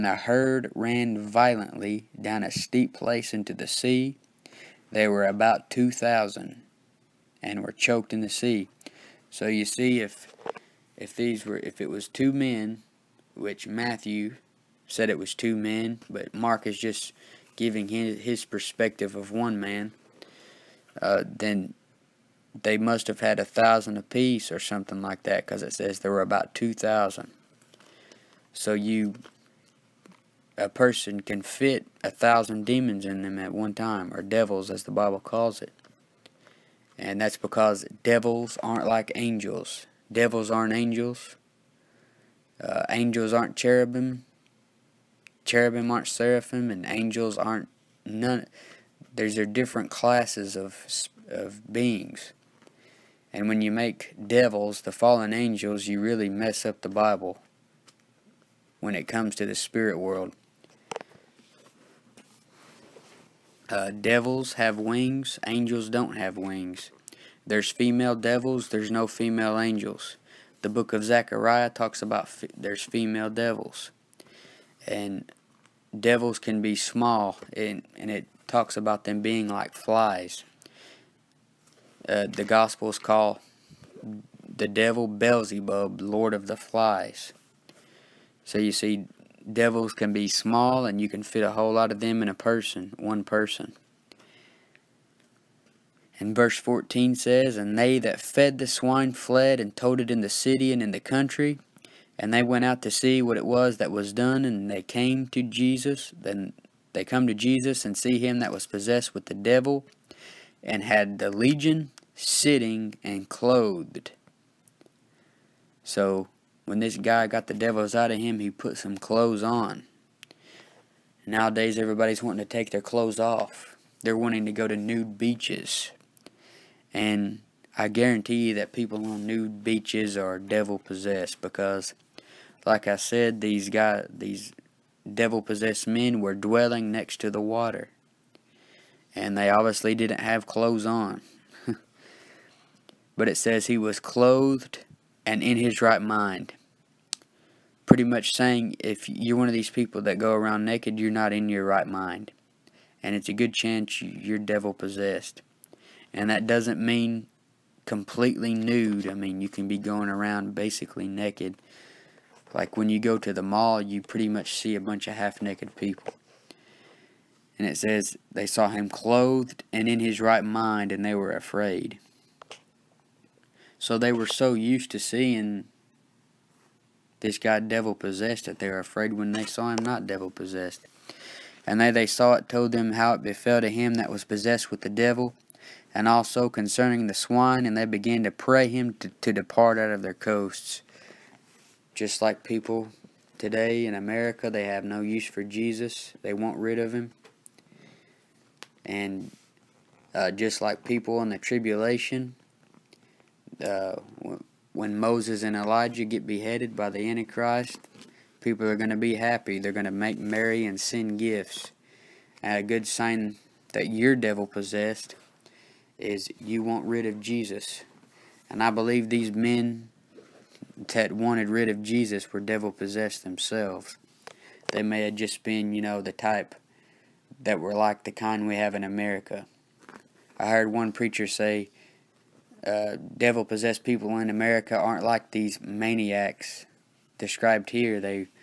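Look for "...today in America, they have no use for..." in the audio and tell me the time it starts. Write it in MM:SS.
03:13.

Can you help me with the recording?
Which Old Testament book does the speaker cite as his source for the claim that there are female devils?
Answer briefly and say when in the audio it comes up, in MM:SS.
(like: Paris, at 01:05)
Zechariah, at 01:10.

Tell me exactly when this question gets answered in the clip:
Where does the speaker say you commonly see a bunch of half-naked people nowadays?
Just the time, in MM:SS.
02:43.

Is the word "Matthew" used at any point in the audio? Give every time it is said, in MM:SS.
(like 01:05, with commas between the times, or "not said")
00:13.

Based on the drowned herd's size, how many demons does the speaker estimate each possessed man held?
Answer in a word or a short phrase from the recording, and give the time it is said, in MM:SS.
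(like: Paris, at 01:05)
1000 apiece, at 00:23.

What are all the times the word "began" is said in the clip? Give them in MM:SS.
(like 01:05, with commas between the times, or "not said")
03:07.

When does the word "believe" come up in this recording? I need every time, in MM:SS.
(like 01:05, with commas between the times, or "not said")
03:38.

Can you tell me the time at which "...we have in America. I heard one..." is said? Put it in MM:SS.
03:48.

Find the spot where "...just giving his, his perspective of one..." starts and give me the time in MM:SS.
00:16.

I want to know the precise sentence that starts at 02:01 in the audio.
Nowadays, everybody's wanting to take their clothes off.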